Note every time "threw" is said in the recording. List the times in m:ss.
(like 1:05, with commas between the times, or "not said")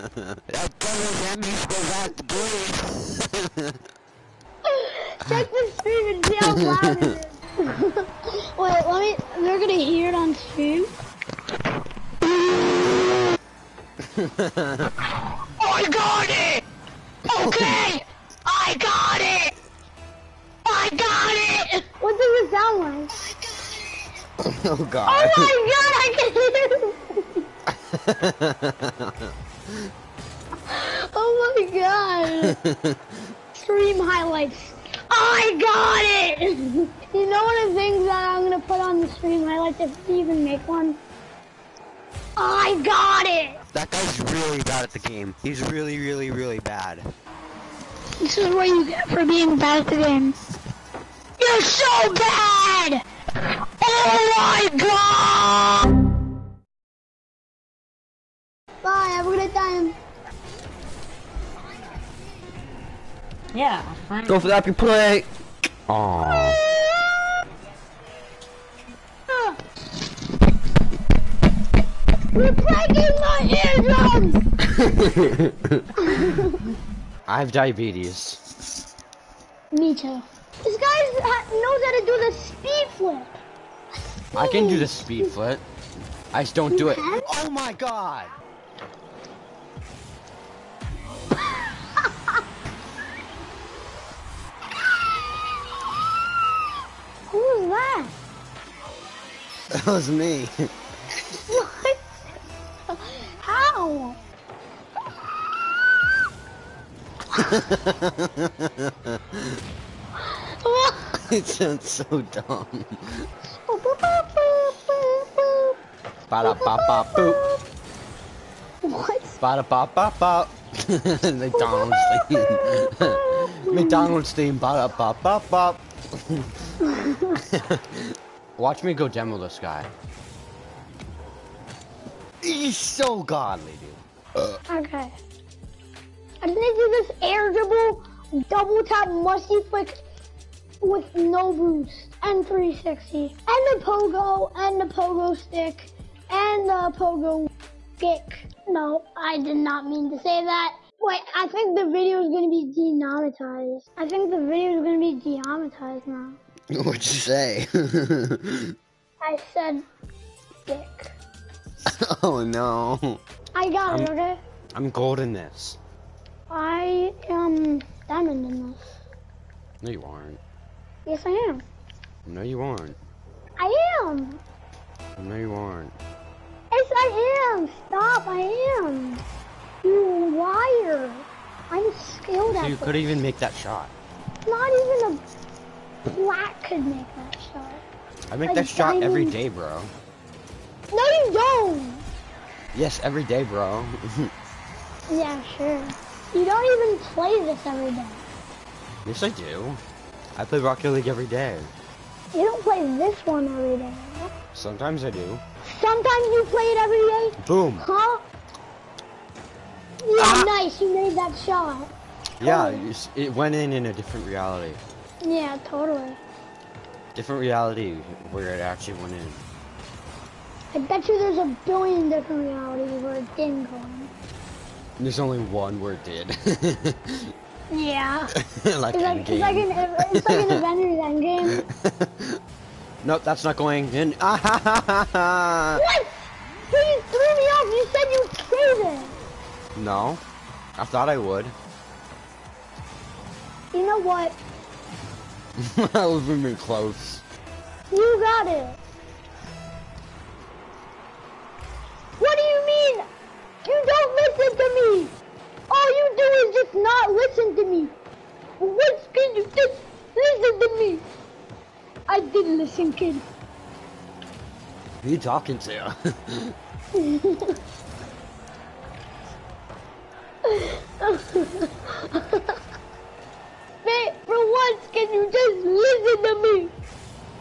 3:57.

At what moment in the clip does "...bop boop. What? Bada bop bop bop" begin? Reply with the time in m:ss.
1:56.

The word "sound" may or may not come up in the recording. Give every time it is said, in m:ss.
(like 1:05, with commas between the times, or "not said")
0:22, 1:51.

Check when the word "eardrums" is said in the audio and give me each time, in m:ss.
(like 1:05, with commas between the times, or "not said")
1:14.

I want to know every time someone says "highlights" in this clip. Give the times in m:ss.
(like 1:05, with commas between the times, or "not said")
0:33, 0:39.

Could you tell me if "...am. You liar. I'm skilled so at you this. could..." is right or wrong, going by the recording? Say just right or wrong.
right.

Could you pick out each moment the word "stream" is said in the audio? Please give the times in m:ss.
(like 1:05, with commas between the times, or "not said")
0:05, 0:10, 0:33, 0:39.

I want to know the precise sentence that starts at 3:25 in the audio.
Sometimes you play it every day?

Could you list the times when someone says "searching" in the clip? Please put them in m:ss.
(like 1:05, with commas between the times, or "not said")
not said.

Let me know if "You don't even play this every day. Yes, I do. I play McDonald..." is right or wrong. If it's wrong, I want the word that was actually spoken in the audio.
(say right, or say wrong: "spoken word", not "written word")
wrong: "Rocket", not "McDonald".